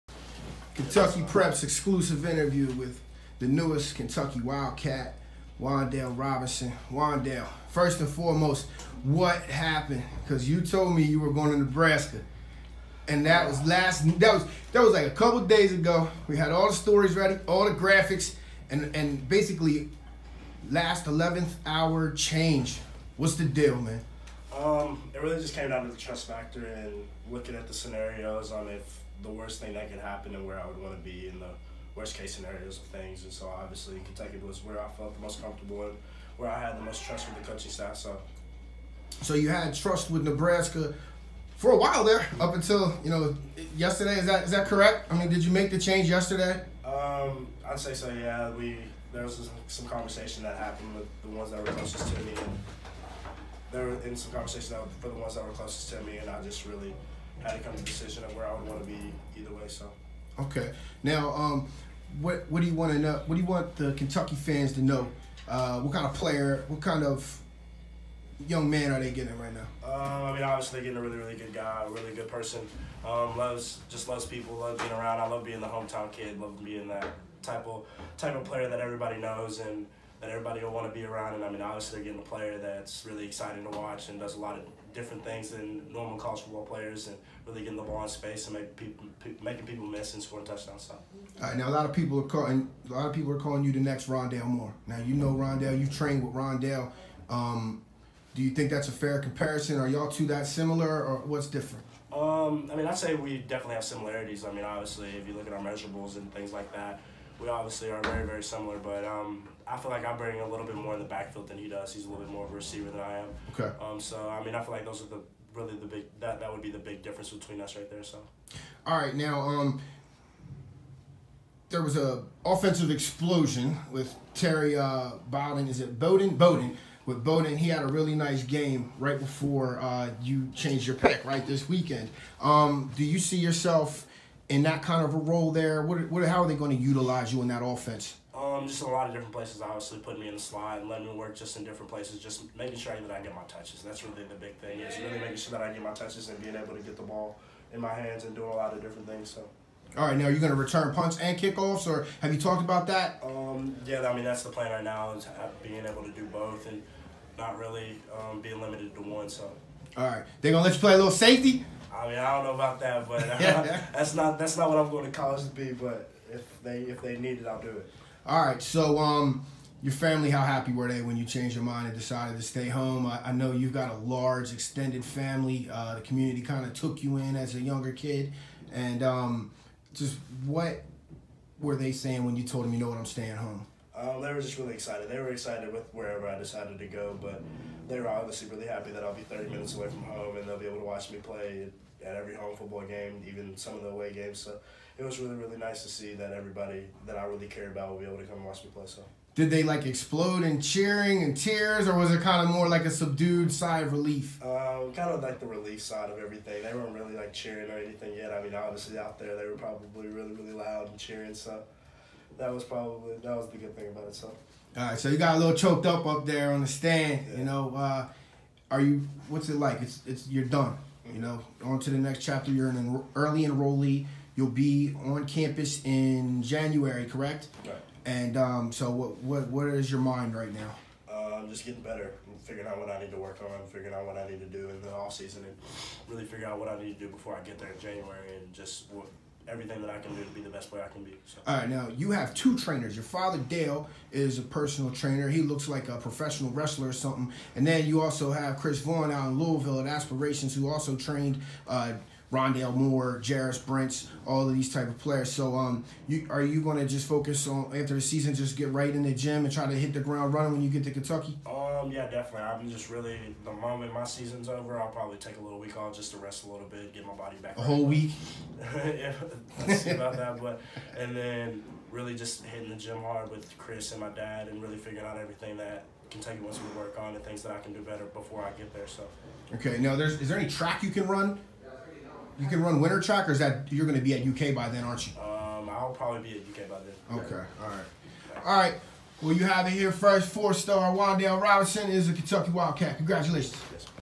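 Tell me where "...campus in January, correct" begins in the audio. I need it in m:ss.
3:45.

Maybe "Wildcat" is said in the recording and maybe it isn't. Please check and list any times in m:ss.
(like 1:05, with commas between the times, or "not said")
0:04, 4:52.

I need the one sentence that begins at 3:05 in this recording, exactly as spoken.
They were excited with wherever I decided to go, but they were obviously really happy that I'll be 30 mm-hmm.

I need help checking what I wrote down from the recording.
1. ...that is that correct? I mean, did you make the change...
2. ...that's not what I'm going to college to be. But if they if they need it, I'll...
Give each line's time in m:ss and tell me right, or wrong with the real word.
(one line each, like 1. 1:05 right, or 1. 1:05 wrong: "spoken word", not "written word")
1. 0:44 right
2. 2:44 right.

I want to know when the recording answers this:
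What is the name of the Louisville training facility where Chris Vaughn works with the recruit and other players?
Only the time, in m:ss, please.
4:09.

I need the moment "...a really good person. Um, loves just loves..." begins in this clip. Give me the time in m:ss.
1:11.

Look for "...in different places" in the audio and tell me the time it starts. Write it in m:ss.
2:21.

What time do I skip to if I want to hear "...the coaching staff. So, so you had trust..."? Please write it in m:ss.
0:37.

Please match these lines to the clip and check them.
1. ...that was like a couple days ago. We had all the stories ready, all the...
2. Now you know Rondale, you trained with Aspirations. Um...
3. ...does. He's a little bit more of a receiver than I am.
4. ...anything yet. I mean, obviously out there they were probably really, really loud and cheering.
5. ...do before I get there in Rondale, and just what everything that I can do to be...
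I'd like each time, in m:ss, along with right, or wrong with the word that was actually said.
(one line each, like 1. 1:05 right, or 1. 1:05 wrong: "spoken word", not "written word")
1. 0:14 right
2. 1:34 wrong: "Rondell", not "Aspirations"
3. 1:51 right
4. 3:27 right
5. 3:56 wrong: "January", not "Rondale".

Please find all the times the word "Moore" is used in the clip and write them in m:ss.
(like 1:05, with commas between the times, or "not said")
1:34, 4:12.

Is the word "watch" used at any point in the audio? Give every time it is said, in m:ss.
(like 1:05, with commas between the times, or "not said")
1:23, 3:10, 3:18.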